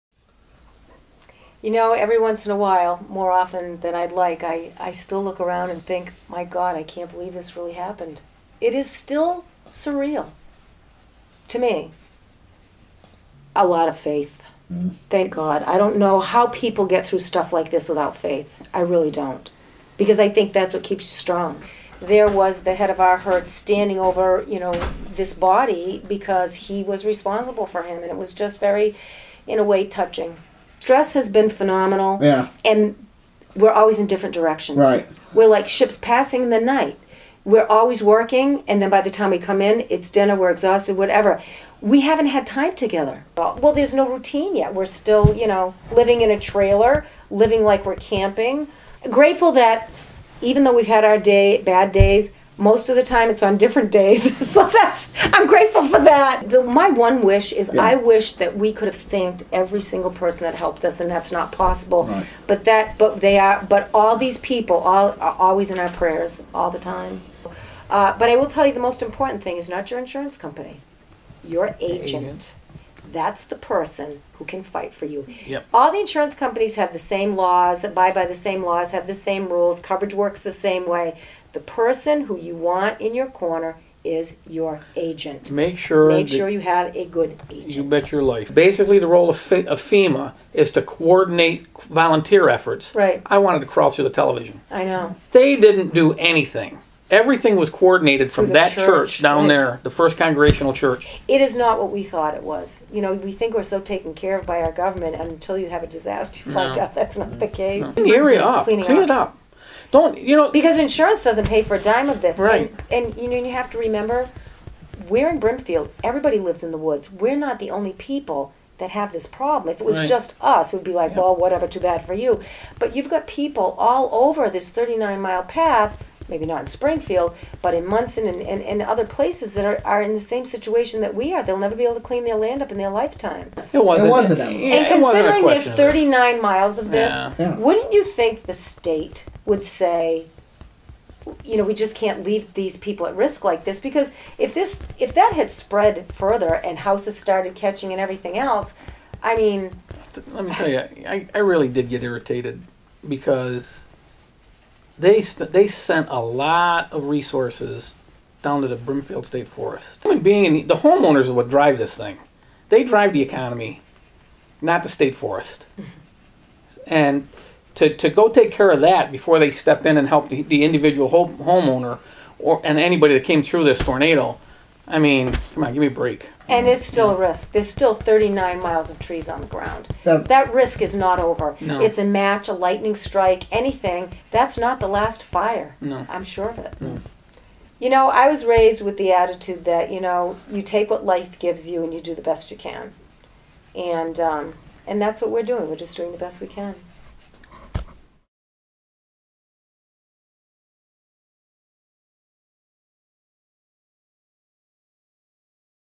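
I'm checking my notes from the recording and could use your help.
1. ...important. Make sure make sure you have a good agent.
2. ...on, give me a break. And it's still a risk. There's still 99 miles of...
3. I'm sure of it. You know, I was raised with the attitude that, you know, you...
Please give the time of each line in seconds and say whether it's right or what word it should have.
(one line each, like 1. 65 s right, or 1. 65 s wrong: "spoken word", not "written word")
1. 84 s wrong: "agent", not "important"
2. 175 s wrong: "39", not "99"
3. 186 s right.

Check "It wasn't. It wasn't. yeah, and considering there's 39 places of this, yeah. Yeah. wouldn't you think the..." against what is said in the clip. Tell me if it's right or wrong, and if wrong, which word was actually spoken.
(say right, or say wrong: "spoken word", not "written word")
wrong: "miles", not "places".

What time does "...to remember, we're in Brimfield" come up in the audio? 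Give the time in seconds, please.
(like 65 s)
113 s.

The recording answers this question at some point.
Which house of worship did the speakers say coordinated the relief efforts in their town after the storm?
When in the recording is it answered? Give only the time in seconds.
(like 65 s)
99 s.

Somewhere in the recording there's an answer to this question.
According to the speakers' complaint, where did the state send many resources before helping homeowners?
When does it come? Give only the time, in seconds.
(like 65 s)
158 s.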